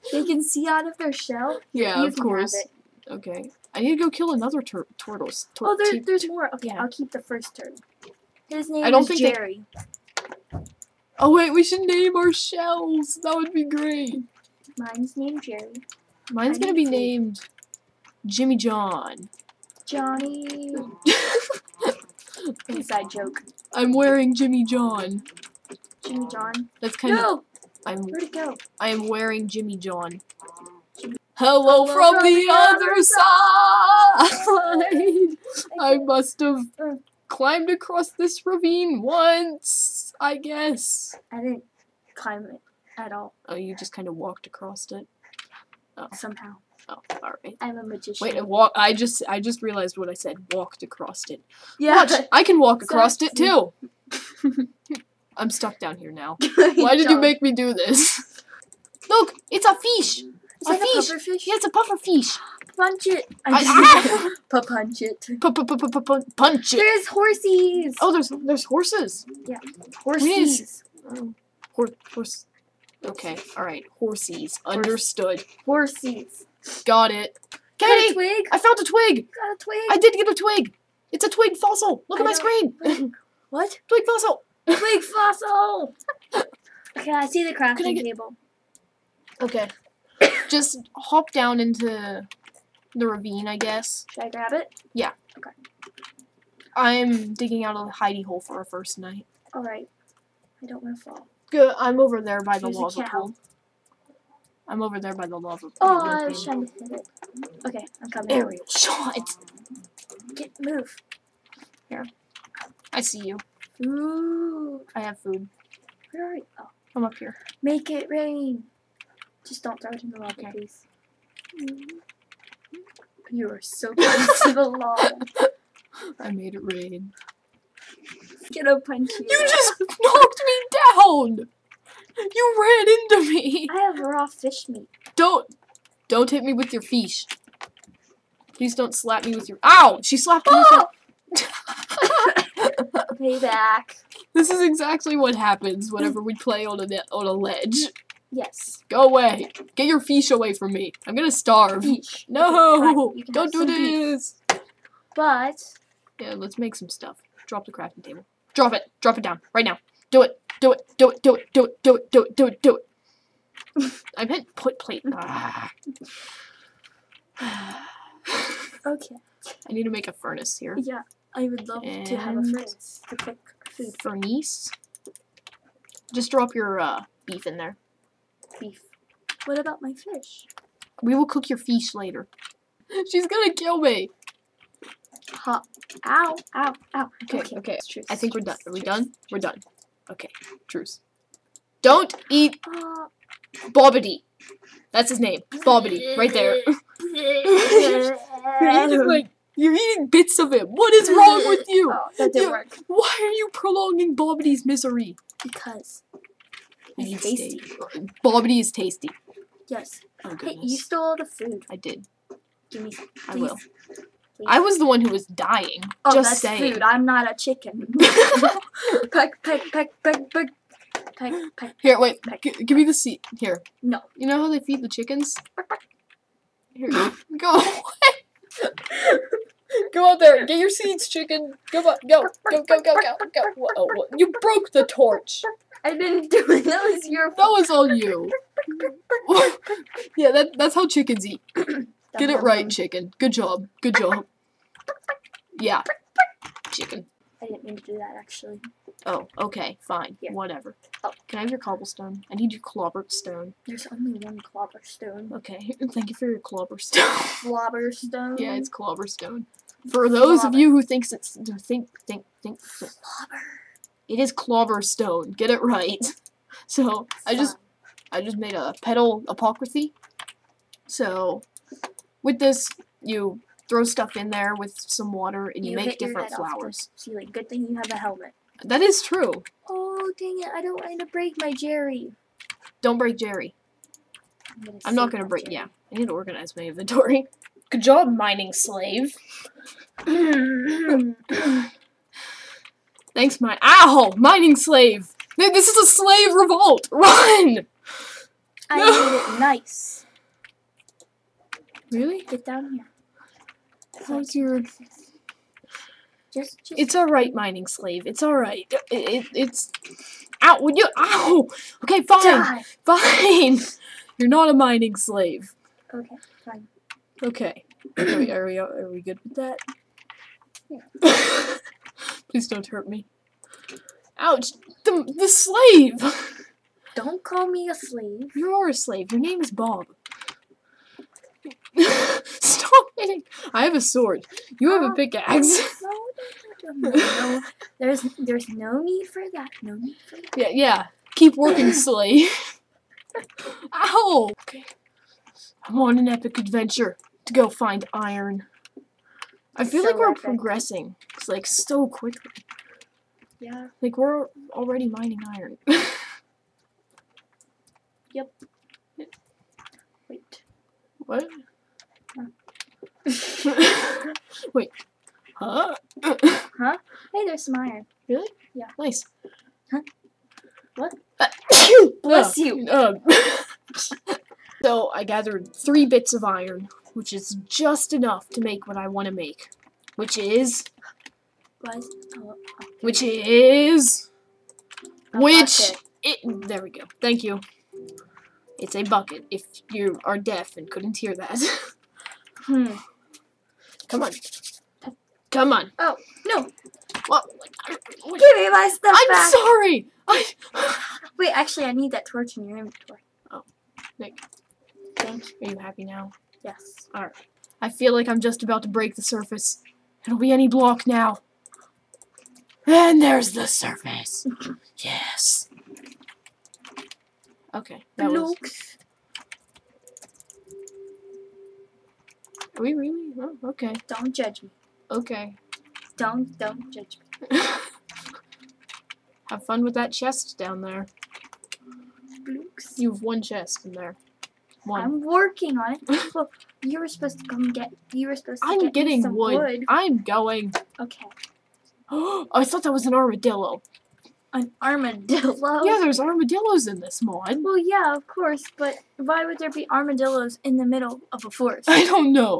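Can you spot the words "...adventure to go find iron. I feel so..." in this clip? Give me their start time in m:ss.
5:46.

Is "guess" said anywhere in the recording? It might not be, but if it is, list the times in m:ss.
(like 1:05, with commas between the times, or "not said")
0:40, 1:33.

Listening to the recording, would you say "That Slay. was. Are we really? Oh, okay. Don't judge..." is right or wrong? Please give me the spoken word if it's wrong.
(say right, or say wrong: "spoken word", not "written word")
wrong: "Blokes", not "Slay".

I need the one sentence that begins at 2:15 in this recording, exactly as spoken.
Don't, don't hit me with your fish.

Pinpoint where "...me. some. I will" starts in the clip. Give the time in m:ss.
3:32.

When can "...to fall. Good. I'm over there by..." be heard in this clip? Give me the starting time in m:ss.
1:40.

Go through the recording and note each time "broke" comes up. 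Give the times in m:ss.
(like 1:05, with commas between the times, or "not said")
3:54.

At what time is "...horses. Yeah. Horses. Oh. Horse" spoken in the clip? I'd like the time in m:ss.
1:08.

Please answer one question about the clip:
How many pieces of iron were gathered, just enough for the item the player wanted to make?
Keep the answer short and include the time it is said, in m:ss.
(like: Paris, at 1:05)
3, at 6:15.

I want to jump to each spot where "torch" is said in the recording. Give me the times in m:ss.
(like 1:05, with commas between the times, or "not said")
3:54, 6:42.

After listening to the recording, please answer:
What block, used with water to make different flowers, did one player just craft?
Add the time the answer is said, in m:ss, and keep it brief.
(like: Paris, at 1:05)
Petal apothecary, at 4:28.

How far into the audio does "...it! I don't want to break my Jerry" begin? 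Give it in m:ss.
4:40.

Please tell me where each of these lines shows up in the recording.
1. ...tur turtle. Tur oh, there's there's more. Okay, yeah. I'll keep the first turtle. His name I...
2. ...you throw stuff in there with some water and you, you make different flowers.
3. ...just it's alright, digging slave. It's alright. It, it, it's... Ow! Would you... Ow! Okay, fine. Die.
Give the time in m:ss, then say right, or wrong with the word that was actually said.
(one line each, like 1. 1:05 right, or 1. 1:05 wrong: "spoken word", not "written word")
1. 0:04 right
2. 4:33 right
3. 5:06 wrong: "mining", not "digging".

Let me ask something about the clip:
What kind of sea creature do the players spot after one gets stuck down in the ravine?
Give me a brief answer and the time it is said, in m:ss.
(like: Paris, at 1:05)
Puffer fish, at 1:01.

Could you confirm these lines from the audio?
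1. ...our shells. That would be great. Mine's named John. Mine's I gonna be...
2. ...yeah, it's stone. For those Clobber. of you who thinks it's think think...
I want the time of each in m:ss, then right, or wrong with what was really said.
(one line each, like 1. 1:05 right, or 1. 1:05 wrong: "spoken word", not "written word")
1. 0:12 wrong: "Jerry", not "John"
2. 4:18 right.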